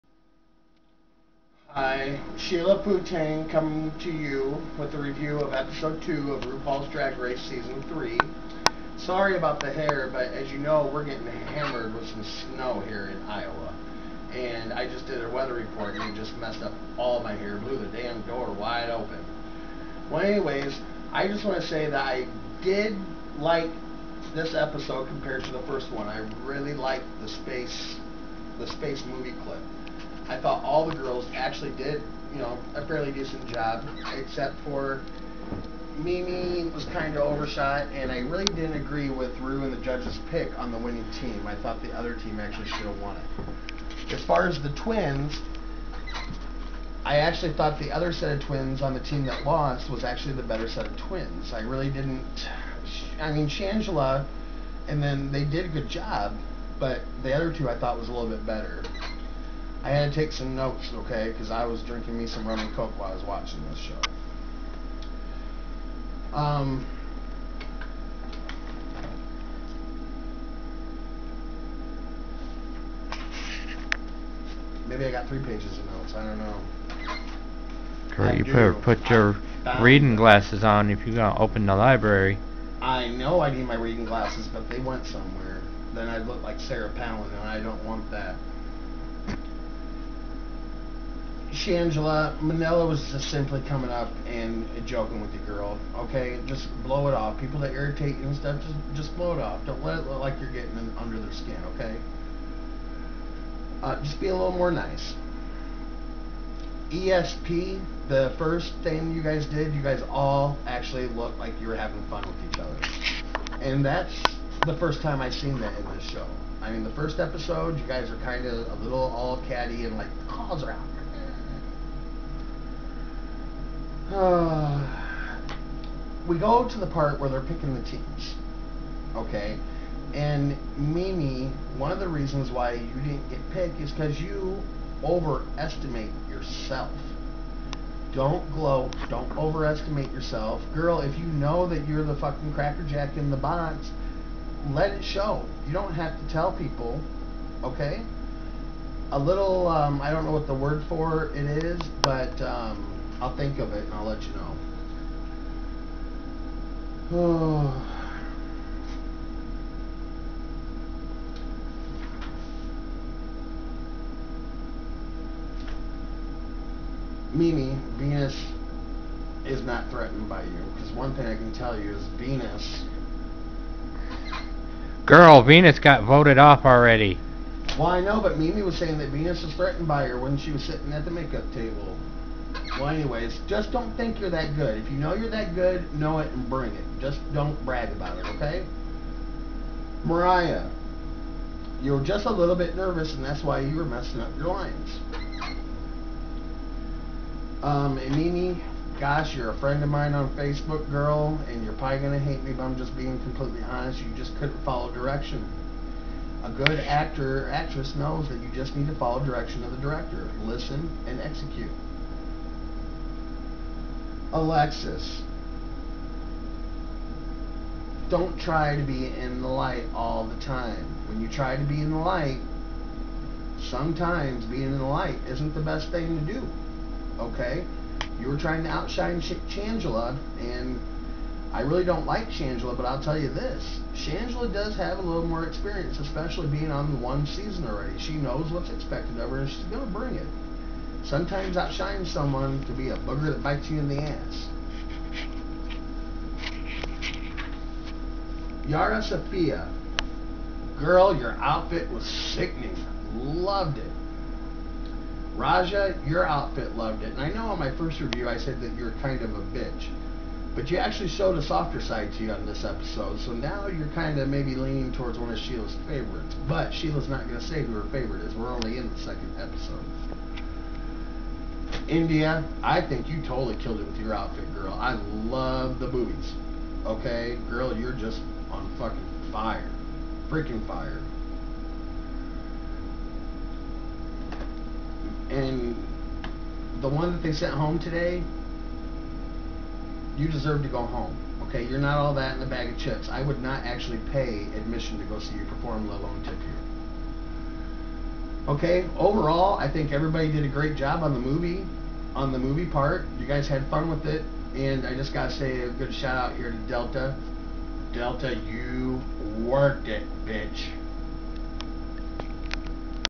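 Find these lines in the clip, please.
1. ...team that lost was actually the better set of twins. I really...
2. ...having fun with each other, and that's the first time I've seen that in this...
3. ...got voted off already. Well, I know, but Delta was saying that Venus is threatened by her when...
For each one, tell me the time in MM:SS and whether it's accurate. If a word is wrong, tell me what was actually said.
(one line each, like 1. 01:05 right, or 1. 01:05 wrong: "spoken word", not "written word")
1. 00:48 right
2. 01:51 right
3. 02:55 wrong: "Mimi", not "Delta".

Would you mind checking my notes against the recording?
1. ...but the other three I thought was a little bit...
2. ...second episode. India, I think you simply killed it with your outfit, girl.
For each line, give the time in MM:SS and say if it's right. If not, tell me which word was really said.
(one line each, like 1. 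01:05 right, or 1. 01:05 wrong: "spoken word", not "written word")
1. 00:56 wrong: "two", not "three"
2. 04:28 wrong: "totally", not "simply".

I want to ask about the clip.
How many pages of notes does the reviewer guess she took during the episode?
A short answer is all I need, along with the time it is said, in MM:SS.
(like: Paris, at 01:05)
3, at 01:15.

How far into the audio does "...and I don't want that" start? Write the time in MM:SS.
01:27.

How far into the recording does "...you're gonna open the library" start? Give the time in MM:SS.
01:21.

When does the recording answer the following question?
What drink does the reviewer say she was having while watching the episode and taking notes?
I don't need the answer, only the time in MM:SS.
01:02.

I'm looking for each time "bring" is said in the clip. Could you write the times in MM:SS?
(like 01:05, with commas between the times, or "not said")
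03:06, 03:59.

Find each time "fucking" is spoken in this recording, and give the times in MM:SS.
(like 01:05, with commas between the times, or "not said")
02:22, 04:38.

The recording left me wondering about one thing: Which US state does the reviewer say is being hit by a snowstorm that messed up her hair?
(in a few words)
Iowa.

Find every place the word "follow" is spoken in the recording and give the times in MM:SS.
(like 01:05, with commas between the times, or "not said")
03:24, 03:28.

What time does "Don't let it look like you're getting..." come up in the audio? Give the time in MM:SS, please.
01:39.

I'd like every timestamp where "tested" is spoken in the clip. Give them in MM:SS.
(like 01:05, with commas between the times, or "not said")
not said.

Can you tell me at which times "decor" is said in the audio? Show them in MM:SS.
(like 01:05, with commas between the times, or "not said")
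not said.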